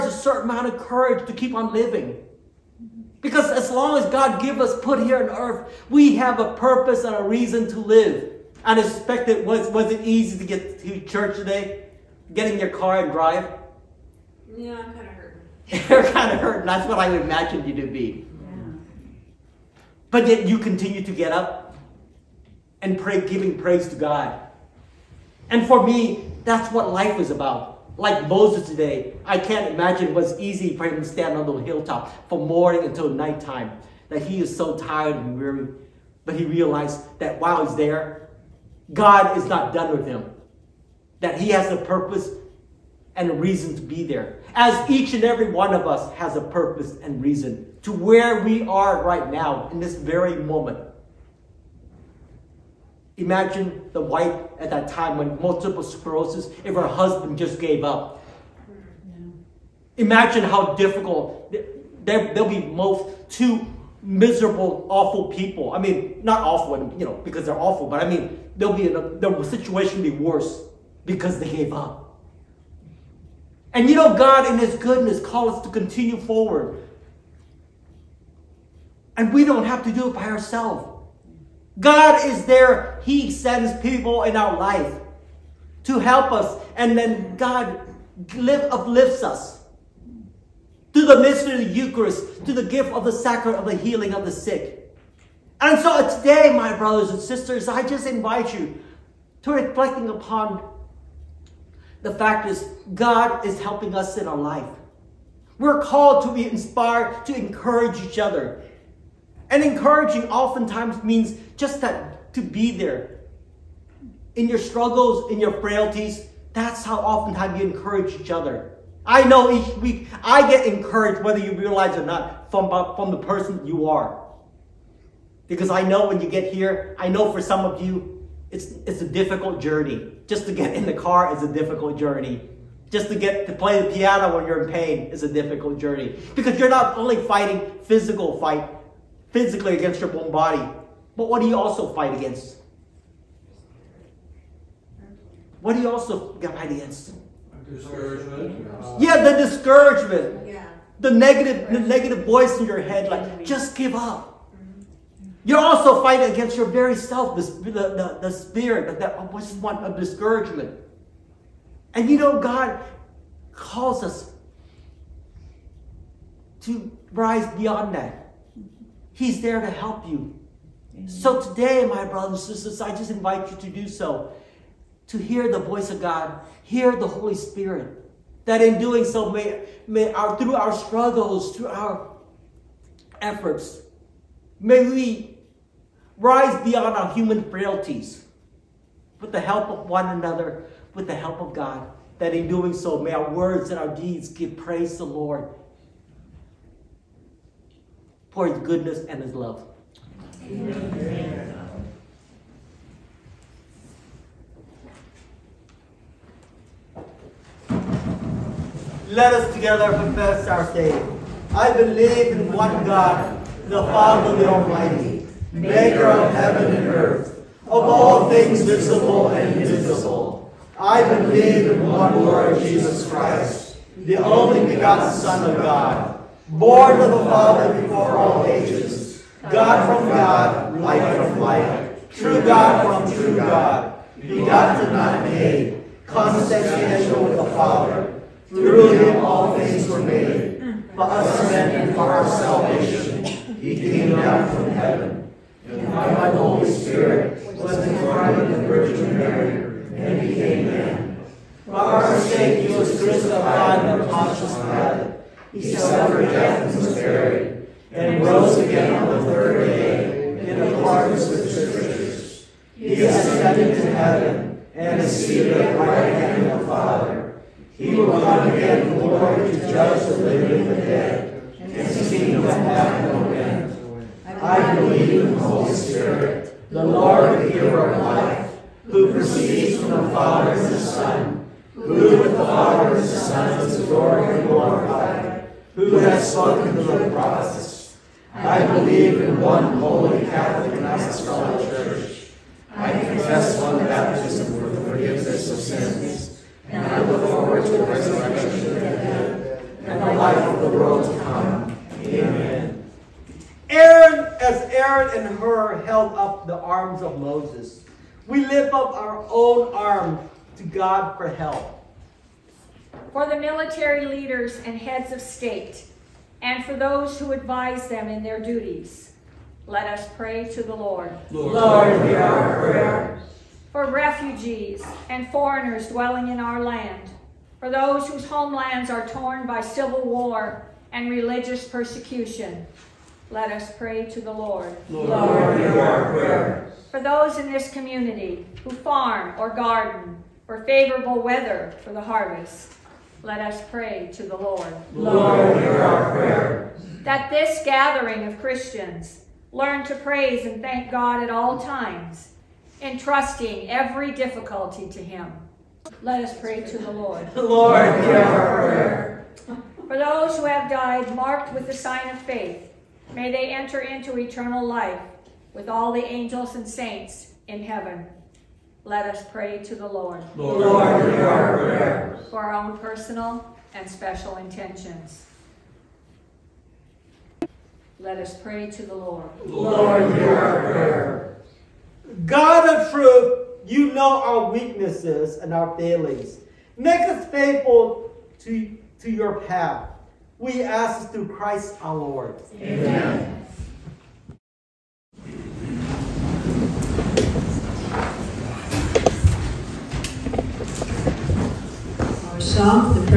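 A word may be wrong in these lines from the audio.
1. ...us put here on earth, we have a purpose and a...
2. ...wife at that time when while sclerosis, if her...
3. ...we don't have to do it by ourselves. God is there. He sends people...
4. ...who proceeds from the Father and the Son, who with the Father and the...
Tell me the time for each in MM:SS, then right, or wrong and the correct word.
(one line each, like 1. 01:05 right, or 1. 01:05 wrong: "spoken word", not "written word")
1. 00:04 right
2. 00:53 wrong: "multiple", not "while"
3. 01:19 right
4. 04:38 right.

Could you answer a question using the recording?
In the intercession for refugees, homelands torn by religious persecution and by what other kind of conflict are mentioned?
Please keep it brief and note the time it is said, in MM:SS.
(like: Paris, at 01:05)
Civil war, at 05:29.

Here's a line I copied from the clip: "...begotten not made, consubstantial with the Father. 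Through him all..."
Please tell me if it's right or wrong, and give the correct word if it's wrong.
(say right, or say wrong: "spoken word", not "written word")
right.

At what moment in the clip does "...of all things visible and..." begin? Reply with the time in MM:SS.
03:37.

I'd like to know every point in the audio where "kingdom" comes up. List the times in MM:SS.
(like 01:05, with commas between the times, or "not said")
04:32.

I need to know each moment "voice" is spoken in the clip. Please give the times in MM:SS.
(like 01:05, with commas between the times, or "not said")
02:32, 02:55.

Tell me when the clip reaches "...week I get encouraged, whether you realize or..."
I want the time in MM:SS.
01:59.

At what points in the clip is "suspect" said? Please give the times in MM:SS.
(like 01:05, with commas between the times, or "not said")
00:08.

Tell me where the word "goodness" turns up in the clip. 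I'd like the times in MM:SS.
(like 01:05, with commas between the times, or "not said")
01:14, 03:18.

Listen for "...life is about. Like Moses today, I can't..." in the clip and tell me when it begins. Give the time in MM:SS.
00:26.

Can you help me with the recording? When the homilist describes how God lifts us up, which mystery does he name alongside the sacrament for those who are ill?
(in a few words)
The Eucharist.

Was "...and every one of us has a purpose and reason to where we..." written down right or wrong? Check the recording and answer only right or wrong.
right.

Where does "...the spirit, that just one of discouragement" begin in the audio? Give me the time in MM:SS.
02:38.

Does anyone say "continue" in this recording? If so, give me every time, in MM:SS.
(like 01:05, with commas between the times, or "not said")
00:20, 01:15.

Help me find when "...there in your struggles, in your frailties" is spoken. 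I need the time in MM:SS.
01:52.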